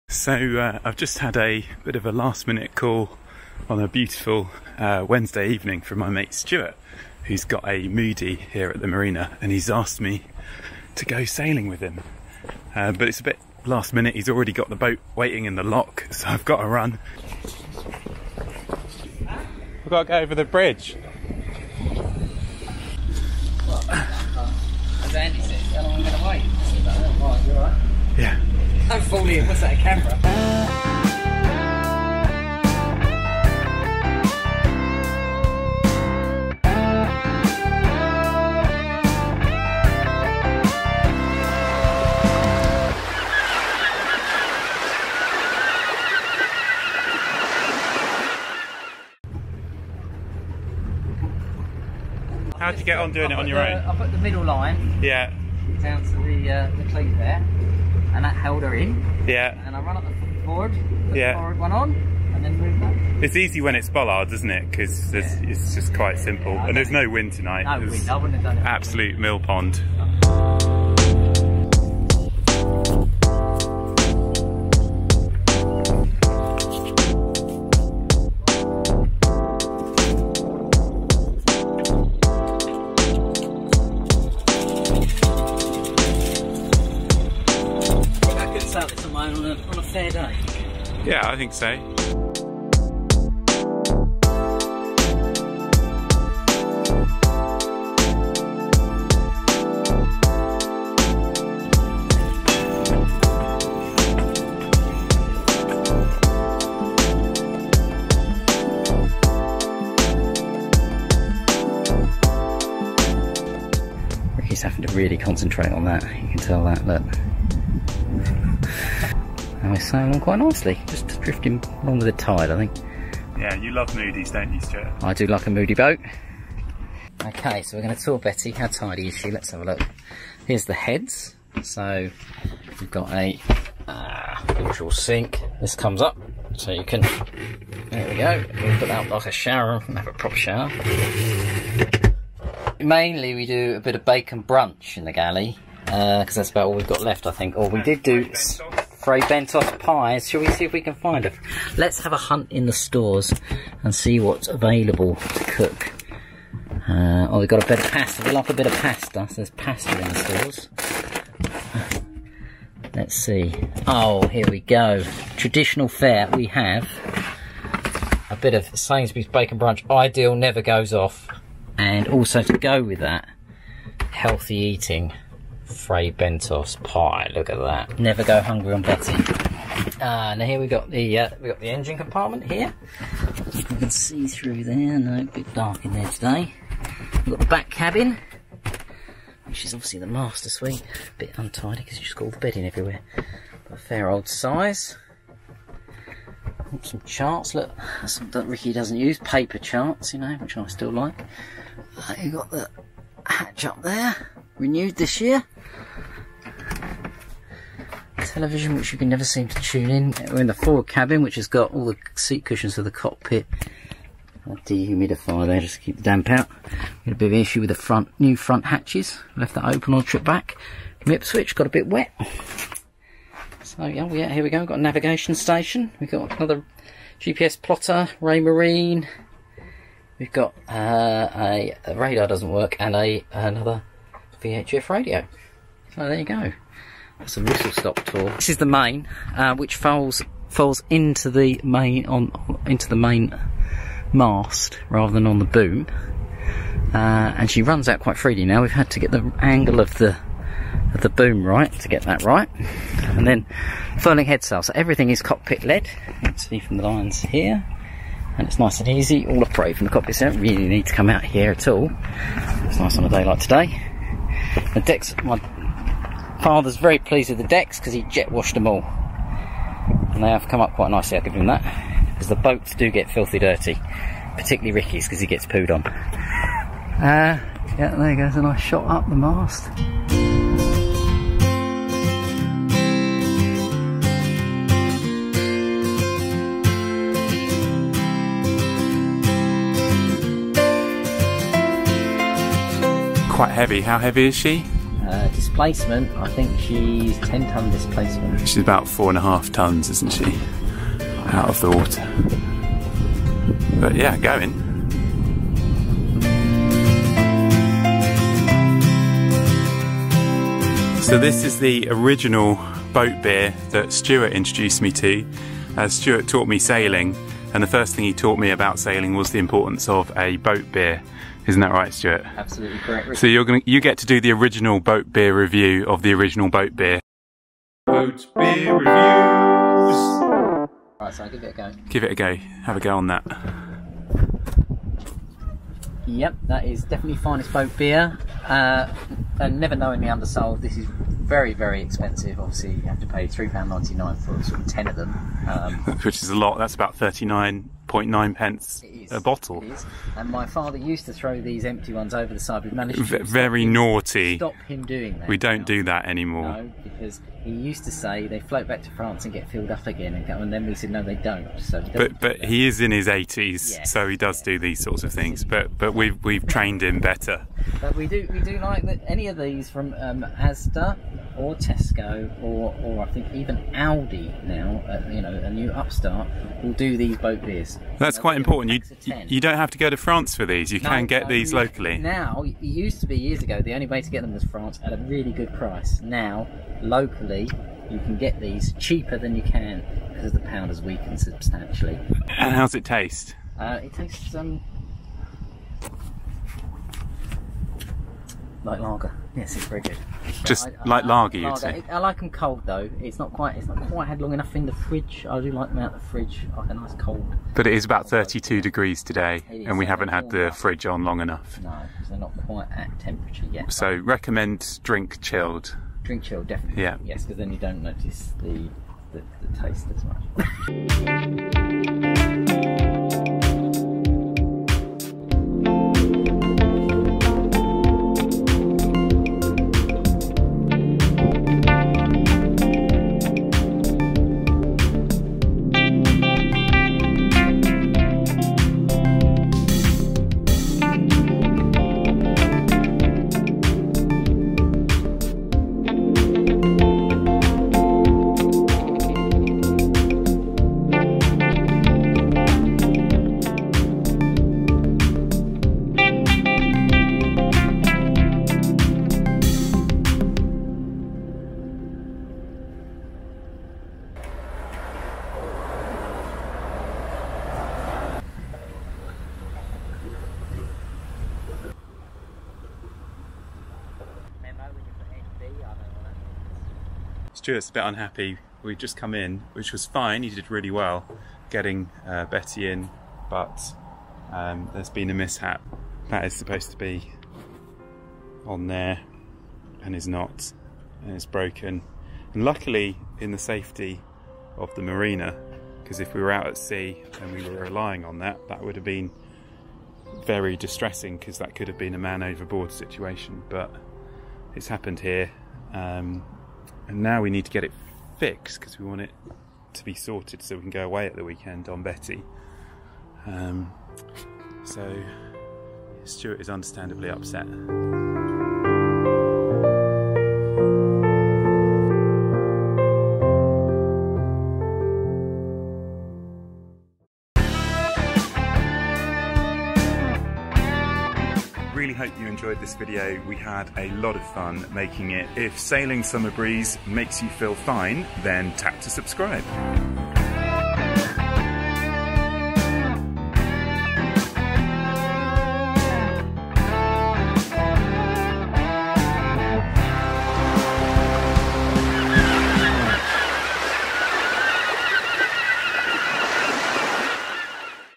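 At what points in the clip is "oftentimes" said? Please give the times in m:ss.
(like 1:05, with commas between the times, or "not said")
not said.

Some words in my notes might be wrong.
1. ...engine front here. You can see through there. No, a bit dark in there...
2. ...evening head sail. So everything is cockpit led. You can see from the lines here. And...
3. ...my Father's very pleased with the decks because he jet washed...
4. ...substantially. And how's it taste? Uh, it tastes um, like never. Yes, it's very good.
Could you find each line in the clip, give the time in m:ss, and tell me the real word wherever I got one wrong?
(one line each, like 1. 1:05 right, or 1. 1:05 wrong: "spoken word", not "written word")
1. 3:01 wrong: "compartment", not "front"
2. 4:13 wrong: "furling", not "evening"
3. 4:25 right
4. 6:31 wrong: "lager", not "never".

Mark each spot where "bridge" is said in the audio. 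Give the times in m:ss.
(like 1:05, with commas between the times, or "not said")
0:20.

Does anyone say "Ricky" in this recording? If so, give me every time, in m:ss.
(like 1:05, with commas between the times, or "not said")
3:18, 4:34.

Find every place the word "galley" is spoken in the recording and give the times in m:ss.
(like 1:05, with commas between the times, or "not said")
2:25.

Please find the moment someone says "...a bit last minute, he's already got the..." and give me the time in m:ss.
0:13.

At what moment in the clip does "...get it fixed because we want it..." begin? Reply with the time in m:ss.
8:27.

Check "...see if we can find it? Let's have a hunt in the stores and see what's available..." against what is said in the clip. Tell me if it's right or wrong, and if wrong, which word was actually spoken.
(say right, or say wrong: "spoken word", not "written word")
right.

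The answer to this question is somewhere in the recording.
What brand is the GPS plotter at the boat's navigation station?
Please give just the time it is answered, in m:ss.
3:48.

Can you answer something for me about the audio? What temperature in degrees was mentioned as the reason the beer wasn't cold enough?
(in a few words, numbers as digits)
32.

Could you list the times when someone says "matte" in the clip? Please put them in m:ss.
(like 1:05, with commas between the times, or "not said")
not said.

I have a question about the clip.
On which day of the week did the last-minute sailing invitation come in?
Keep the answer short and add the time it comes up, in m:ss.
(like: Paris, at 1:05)
Wednesday, at 0:05.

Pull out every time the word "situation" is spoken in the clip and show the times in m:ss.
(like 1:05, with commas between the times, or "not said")
8:22.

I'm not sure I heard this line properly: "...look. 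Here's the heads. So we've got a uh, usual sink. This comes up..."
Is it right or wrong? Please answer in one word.
right.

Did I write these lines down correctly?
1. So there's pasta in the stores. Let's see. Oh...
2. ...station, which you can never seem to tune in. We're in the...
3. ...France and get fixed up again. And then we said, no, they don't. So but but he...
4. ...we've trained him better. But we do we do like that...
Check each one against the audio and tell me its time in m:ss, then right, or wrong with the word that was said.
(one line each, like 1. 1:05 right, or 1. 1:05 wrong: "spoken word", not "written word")
1. 2:39 right
2. 3:28 wrong: "television", not "station"
3. 5:58 wrong: "filled", not "fixed"
4. 6:06 right.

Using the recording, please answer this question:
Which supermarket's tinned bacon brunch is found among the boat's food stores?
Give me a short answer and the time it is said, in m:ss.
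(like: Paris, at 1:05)
Sainsbury's, at 2:48.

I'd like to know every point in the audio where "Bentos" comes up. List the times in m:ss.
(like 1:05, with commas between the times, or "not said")
2:29, 2:56.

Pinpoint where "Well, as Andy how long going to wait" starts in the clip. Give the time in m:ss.
0:23.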